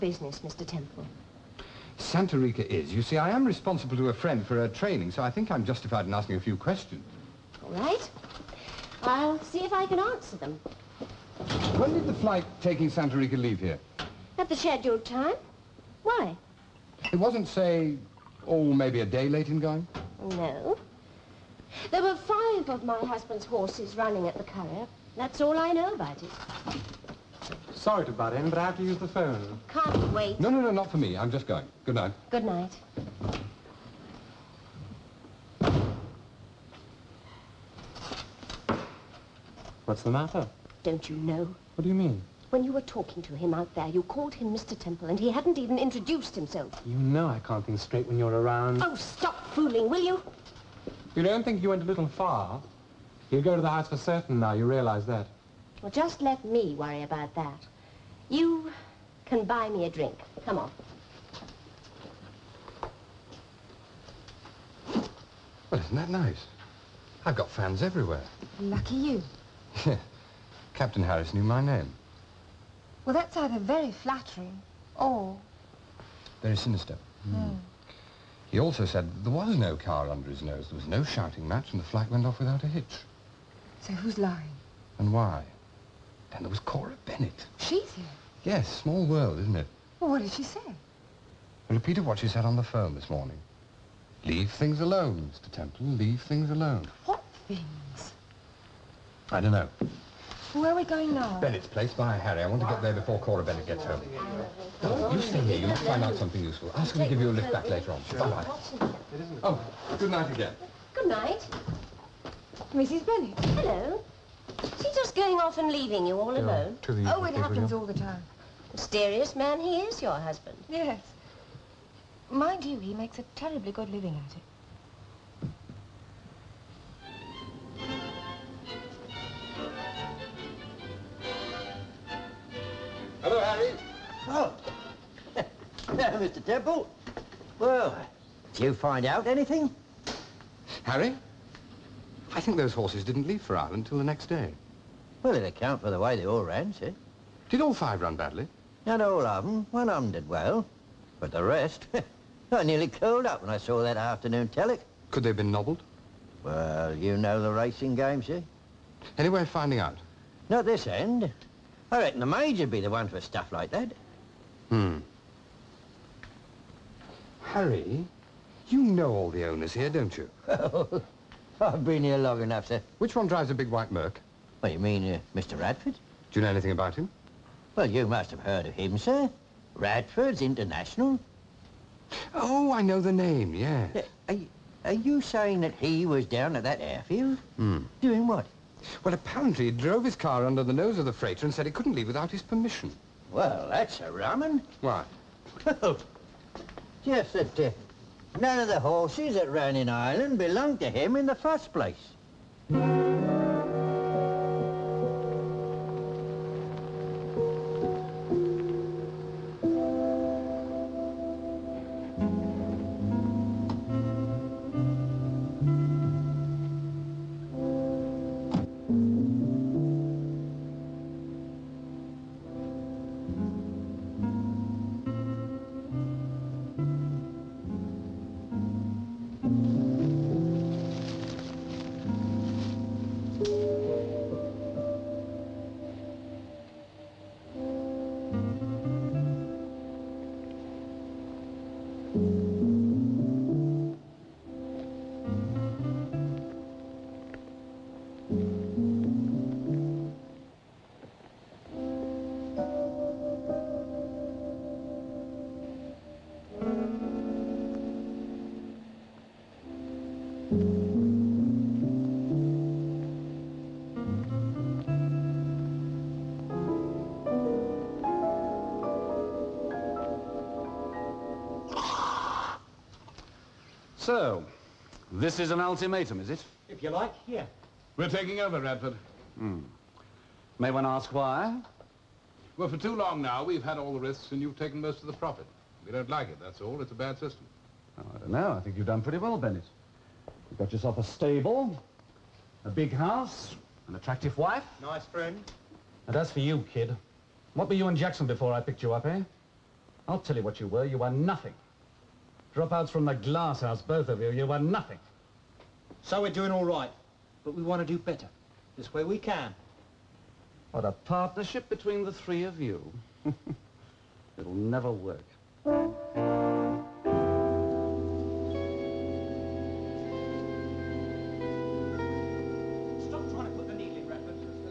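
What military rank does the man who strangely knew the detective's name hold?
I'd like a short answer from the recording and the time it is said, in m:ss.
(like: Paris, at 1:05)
Captain, at 1:10.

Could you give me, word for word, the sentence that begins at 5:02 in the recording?
Dropouts from the glass house, both of you.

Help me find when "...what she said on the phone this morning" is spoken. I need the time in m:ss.
1:32.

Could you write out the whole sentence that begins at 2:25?
Well, it'd account for the way they all ran, sir.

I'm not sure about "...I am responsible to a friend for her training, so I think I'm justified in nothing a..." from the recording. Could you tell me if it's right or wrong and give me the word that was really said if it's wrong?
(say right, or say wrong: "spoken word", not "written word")
wrong: "asking", not "nothing".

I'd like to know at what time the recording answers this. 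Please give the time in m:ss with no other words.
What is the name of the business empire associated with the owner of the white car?
2:59.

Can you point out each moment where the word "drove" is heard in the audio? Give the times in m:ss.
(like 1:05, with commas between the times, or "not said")
3:09.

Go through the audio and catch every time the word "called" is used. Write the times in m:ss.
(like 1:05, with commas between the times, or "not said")
0:44.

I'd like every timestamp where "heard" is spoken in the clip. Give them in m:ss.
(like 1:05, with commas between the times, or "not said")
2:58.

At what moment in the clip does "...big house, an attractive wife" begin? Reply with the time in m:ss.
4:52.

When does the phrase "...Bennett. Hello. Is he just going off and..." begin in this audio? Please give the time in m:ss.
1:53.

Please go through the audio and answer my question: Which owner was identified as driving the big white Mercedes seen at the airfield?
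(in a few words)
Mr. Radford.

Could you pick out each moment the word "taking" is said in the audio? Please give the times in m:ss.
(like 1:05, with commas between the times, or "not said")
0:12, 4:38.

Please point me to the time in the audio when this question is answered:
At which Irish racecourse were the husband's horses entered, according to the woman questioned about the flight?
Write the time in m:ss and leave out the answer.
0:24.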